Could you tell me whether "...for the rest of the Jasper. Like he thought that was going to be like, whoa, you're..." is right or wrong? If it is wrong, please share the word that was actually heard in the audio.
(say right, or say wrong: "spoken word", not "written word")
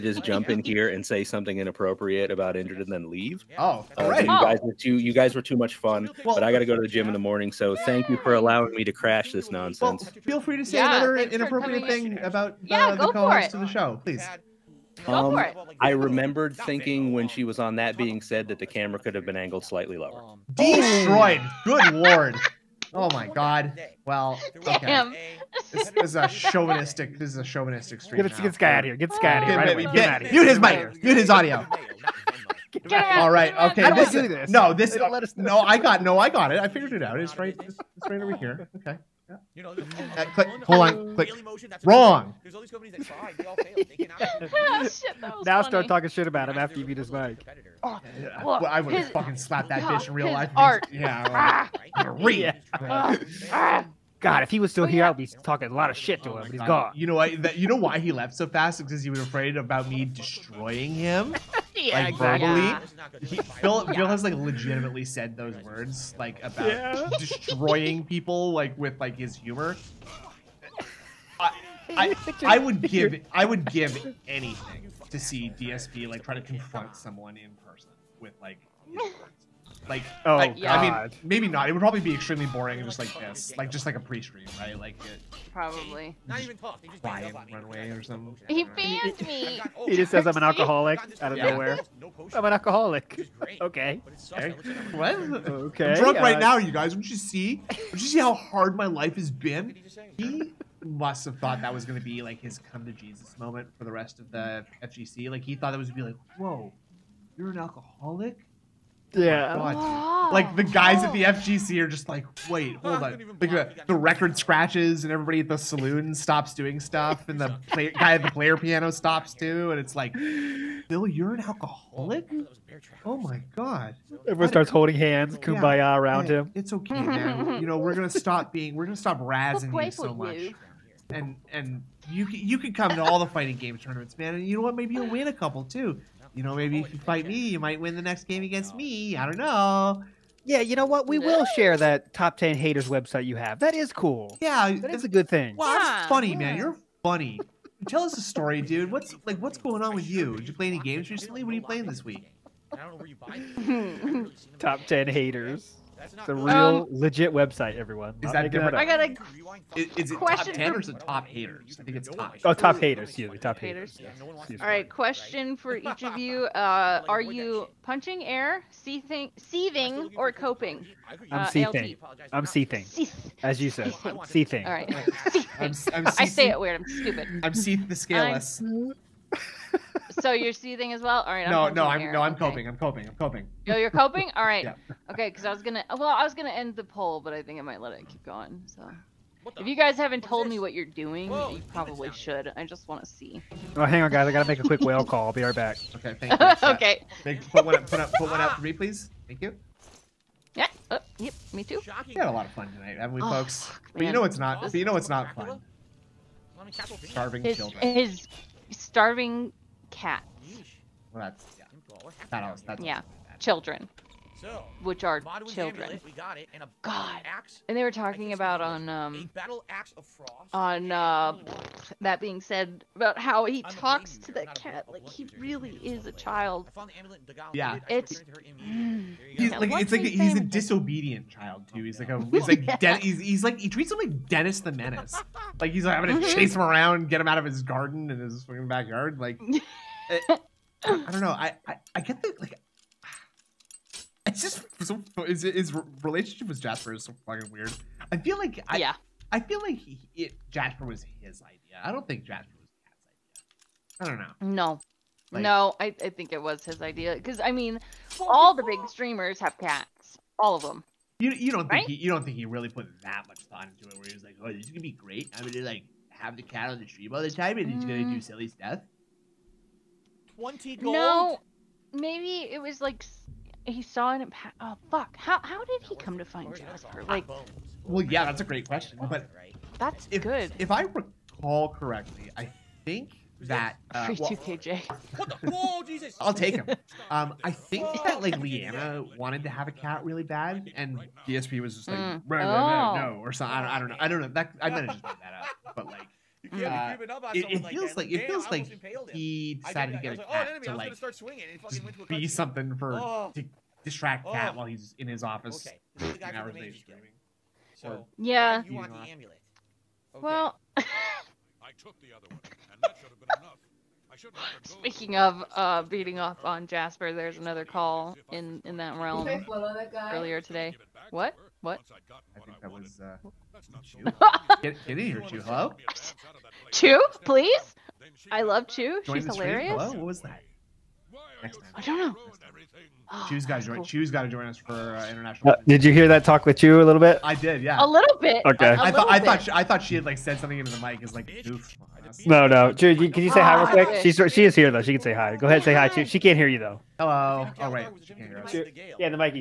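wrong: "FGC", not "Jasper".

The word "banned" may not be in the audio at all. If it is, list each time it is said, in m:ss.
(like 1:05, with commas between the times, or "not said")
1:28.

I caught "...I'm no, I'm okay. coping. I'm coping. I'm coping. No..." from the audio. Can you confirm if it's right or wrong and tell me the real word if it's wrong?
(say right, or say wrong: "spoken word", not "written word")
right.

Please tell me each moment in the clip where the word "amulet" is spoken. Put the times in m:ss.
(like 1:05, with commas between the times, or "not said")
3:36, 5:09.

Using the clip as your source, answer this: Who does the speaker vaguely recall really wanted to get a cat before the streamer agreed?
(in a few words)
Leanna.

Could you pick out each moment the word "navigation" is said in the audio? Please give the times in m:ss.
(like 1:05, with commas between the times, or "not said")
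not said.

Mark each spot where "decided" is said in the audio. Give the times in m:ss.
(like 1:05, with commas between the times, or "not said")
4:59.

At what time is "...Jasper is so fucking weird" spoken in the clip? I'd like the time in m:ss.
4:06.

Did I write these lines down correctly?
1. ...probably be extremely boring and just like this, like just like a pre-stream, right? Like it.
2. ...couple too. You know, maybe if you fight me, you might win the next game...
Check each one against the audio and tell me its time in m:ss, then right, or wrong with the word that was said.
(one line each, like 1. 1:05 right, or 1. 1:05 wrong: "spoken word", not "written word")
1. 1:21 right
2. 2:15 right.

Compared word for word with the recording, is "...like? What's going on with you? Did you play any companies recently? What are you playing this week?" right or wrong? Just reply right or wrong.
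wrong.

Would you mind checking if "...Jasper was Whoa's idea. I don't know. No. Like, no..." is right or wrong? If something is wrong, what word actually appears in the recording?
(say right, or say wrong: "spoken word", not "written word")
wrong: "Cat", not "Whoa".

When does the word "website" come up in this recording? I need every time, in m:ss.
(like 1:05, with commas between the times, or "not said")
2:22, 2:37.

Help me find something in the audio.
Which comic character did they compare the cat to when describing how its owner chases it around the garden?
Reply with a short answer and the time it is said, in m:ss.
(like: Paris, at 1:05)
Dennis the Menace, at 3:54.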